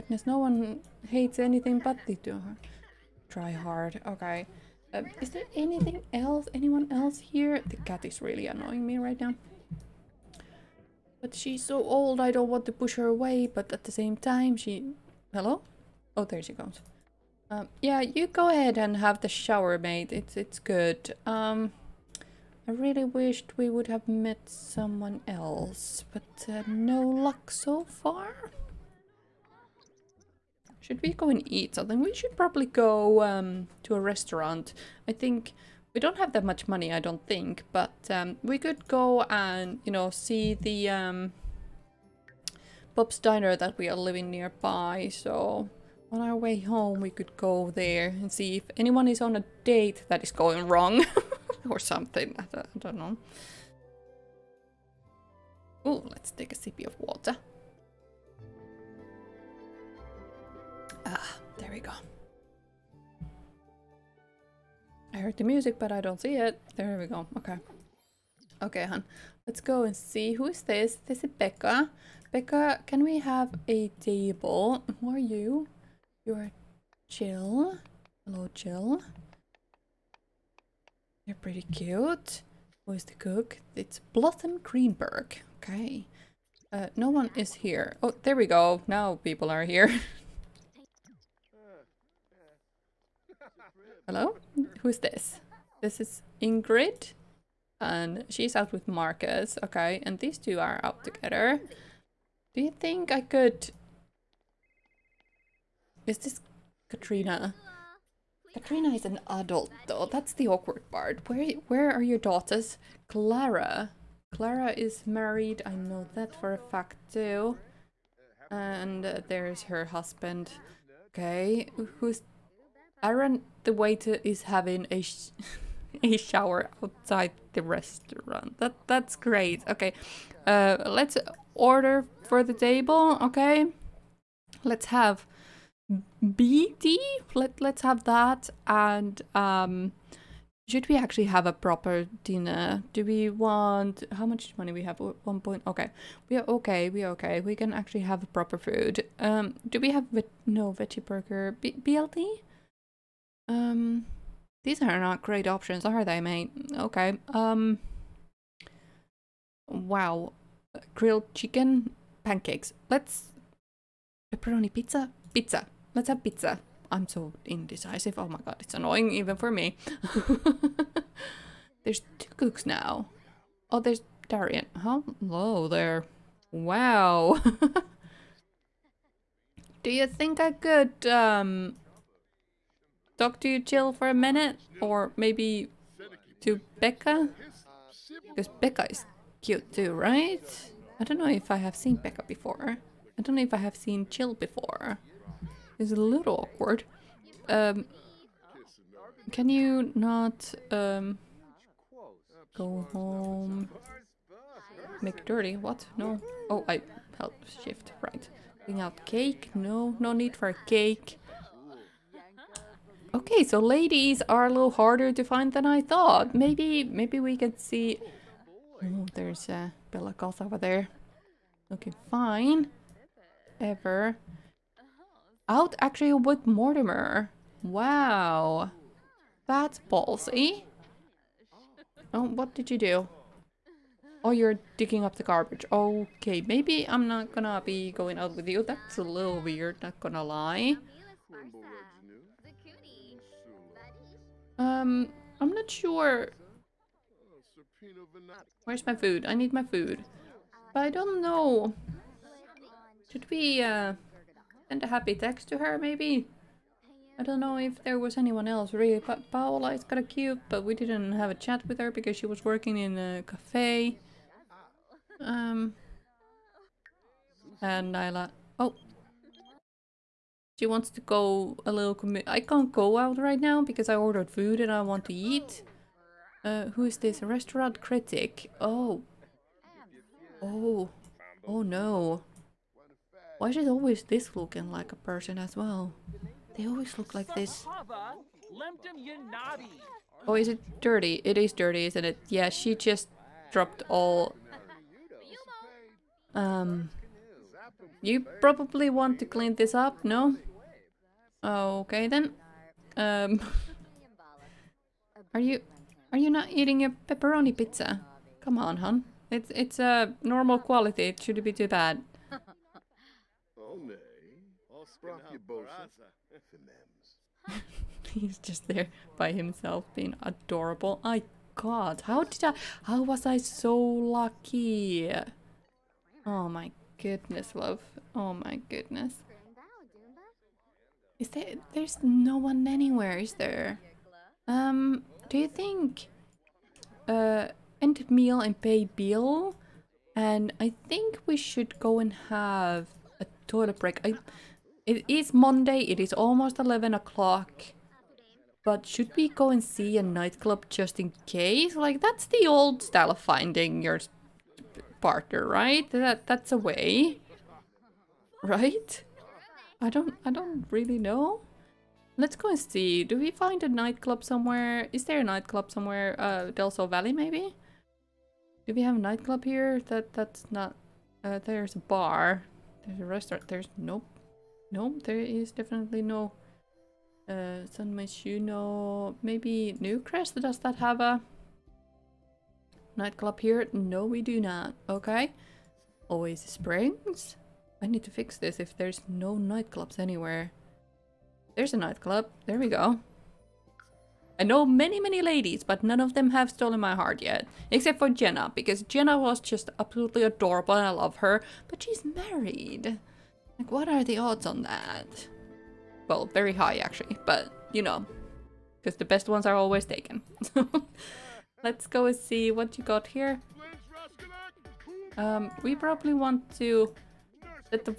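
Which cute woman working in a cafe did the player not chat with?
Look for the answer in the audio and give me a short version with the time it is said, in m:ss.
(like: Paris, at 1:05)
Paola, at 4:19.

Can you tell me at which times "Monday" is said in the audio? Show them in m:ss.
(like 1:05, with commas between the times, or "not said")
5:45.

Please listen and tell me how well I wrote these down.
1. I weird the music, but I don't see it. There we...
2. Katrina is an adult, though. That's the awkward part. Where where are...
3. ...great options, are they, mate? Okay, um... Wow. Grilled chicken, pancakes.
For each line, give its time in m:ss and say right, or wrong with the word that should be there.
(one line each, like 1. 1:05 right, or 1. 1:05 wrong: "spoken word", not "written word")
1. 1:05 wrong: "heard", not "weird"
2. 1:48 right
3. 2:35 right.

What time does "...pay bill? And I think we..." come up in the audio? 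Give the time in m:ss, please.
5:38.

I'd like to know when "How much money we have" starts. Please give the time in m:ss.
2:24.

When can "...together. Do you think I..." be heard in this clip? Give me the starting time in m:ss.
1:41.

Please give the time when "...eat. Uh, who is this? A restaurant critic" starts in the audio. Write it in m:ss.
4:35.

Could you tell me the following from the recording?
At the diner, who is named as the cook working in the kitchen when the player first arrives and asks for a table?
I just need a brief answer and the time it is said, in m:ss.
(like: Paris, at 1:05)
Blossom Greenberg, at 1:24.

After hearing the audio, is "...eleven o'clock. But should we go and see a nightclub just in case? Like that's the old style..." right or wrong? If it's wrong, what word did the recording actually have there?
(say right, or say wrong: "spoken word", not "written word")
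right.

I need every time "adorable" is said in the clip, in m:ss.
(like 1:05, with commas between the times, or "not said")
5:20, 6:40.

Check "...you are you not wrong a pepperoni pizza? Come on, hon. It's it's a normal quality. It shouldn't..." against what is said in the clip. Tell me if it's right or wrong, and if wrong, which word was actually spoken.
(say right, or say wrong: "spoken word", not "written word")
wrong: "eating", not "wrong".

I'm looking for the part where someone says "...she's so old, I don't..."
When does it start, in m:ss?
0:11.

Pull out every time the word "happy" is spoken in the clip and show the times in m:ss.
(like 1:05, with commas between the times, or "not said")
4:14.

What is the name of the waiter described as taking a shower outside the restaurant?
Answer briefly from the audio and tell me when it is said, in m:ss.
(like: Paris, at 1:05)
Aaron, at 2:03.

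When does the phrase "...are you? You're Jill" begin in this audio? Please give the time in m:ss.
1:15.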